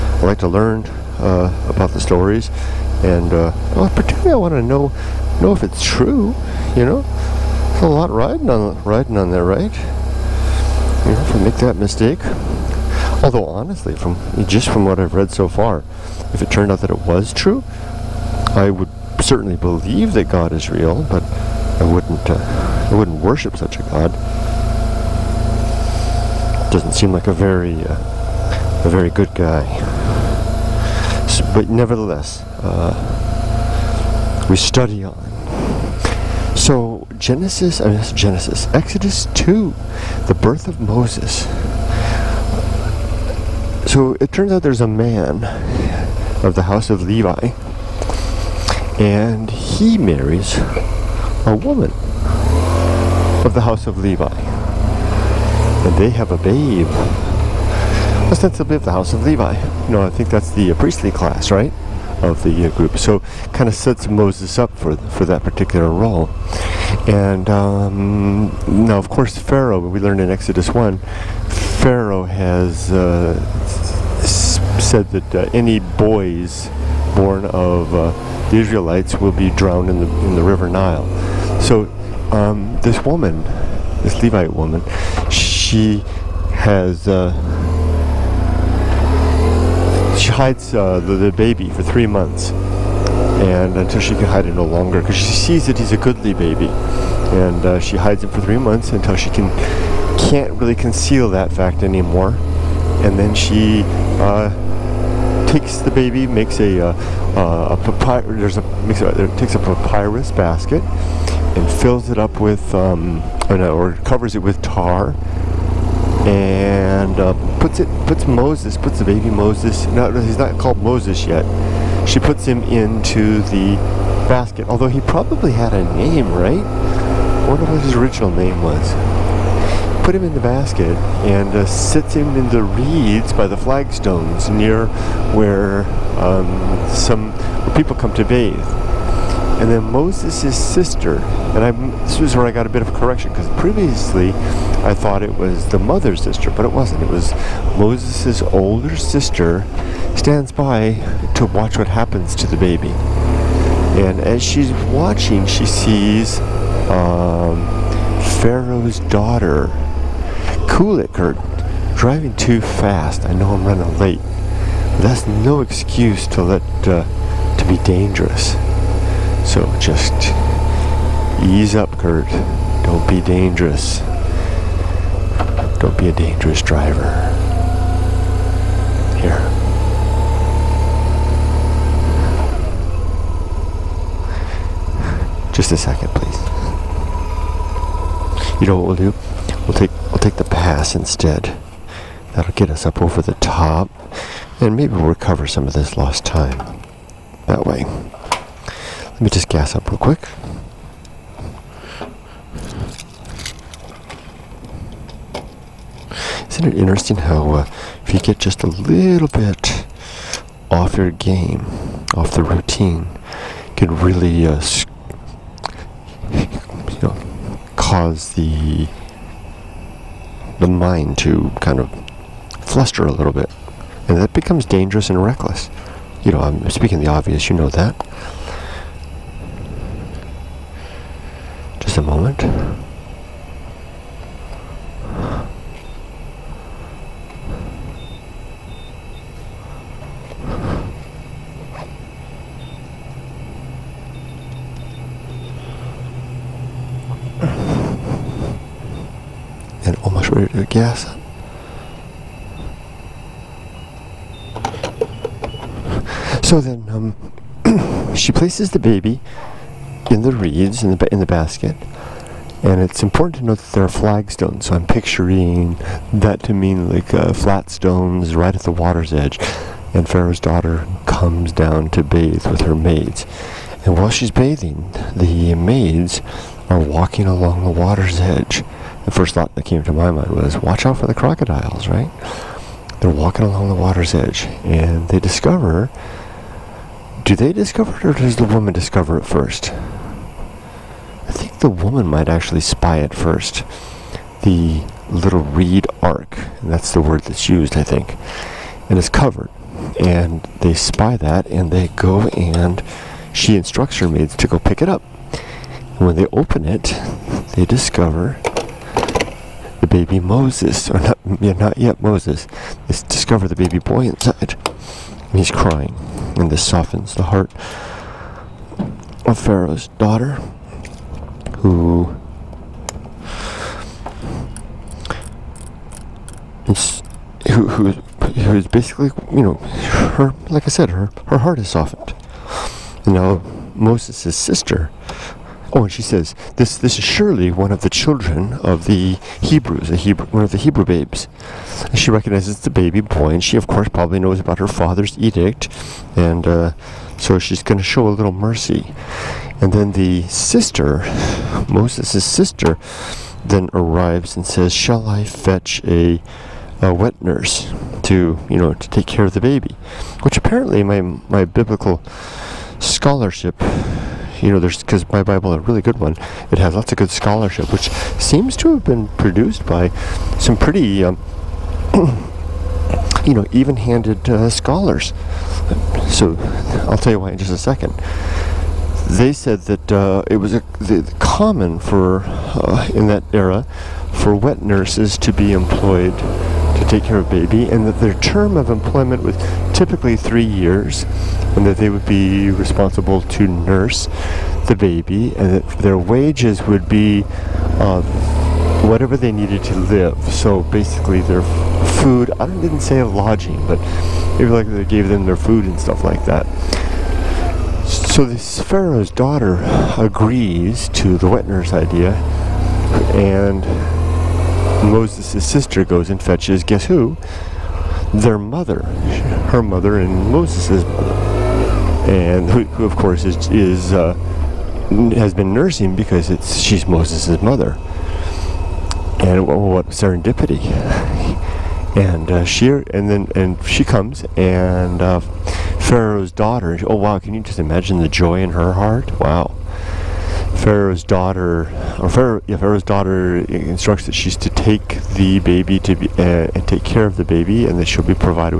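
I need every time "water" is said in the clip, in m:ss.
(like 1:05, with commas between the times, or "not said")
4:28, 4:37, 4:43.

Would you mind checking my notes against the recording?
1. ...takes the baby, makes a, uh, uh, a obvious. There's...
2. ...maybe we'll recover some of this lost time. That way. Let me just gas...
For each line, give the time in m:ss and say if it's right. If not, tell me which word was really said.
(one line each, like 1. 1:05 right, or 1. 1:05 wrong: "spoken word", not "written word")
1. 1:45 wrong: "papyrus", not "obvious"
2. 3:14 right.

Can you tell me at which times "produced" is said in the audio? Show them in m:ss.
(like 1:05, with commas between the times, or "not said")
6:09.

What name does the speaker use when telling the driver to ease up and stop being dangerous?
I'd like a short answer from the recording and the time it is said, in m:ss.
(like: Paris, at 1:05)
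Kurt, at 2:51.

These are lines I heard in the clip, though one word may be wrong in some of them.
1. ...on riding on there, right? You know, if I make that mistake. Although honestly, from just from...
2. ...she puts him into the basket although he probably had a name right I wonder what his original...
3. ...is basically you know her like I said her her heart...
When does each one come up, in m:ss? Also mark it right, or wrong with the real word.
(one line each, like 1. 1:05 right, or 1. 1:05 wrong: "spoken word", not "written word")
1. 0:08 right
2. 2:02 right
3. 5:28 right.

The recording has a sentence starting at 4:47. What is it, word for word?
Do they discover it or does the woman discover it first?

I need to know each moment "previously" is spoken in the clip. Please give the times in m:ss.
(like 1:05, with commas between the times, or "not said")
2:23.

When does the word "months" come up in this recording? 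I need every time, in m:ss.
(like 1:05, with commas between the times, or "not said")
1:32, 1:38.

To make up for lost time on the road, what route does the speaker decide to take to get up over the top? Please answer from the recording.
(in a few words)
the pass.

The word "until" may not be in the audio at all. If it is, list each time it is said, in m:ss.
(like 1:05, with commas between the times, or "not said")
1:33, 1:38.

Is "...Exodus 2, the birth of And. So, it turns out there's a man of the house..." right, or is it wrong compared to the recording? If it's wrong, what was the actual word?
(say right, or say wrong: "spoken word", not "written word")
wrong: "Moses", not "And".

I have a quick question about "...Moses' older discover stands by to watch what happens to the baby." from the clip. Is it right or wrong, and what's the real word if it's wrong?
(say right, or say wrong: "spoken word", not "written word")
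wrong: "sister", not "discover".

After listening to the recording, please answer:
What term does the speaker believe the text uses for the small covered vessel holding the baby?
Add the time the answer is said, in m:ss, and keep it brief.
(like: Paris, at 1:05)
reed ark, at 4:55.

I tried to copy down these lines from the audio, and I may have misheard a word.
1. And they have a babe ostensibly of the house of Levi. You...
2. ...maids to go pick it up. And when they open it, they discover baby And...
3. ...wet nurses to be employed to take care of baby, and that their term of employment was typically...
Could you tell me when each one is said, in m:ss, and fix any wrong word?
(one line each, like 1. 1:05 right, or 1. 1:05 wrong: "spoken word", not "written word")
1. 0:55 right
2. 5:04 wrong: "Moses", not "And"
3. 6:24 right.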